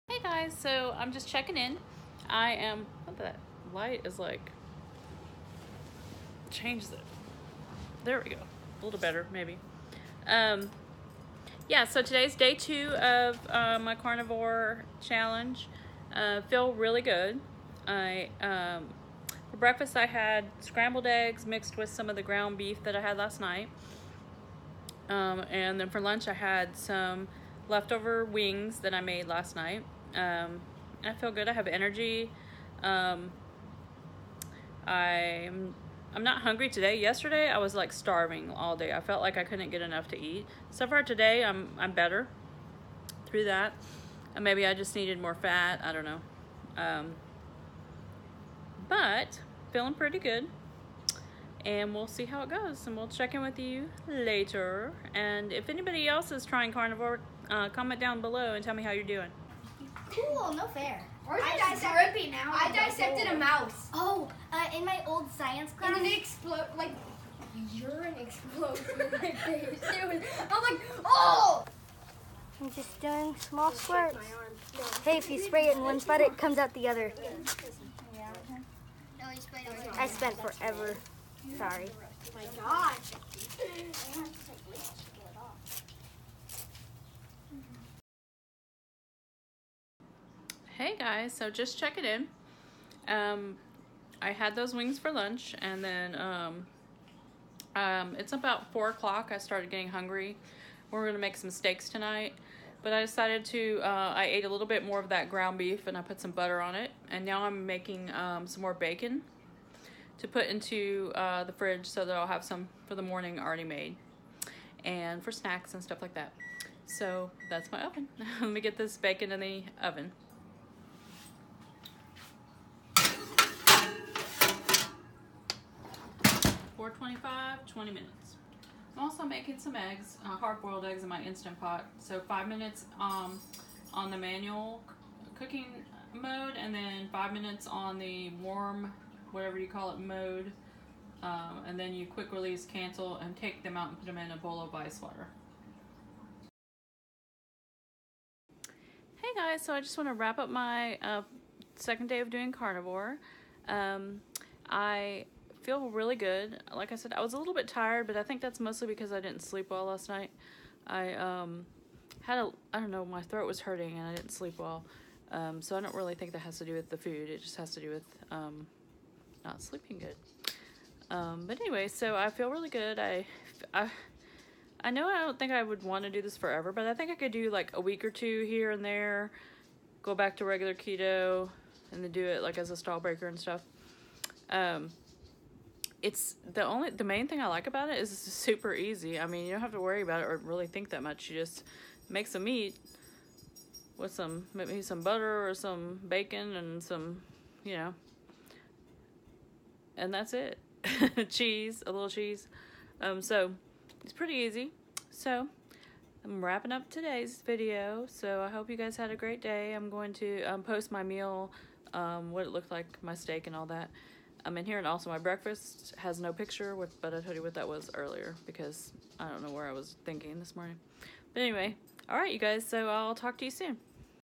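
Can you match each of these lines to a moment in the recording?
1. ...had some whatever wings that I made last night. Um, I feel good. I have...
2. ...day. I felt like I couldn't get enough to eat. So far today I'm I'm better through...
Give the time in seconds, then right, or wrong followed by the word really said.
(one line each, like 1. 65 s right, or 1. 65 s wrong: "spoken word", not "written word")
1. 26 s wrong: "leftover", not "whatever"
2. 38 s right.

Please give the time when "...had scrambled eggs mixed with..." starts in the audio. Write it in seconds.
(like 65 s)
20 s.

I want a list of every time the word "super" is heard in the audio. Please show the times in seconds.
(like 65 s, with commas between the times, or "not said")
188 s.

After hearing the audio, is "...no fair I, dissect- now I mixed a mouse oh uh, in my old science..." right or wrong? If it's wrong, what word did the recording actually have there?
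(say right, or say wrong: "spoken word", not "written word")
wrong: "dissected", not "mixed".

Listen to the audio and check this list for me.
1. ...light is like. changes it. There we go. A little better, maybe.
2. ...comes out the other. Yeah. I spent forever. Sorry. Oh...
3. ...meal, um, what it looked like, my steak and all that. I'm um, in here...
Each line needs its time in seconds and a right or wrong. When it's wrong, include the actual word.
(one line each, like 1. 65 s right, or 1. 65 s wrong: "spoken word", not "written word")
1. 3 s right
2. 76 s right
3. 211 s right.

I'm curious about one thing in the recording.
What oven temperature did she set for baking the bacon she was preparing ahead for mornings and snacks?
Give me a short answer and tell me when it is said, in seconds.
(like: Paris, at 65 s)
425, at 126 s.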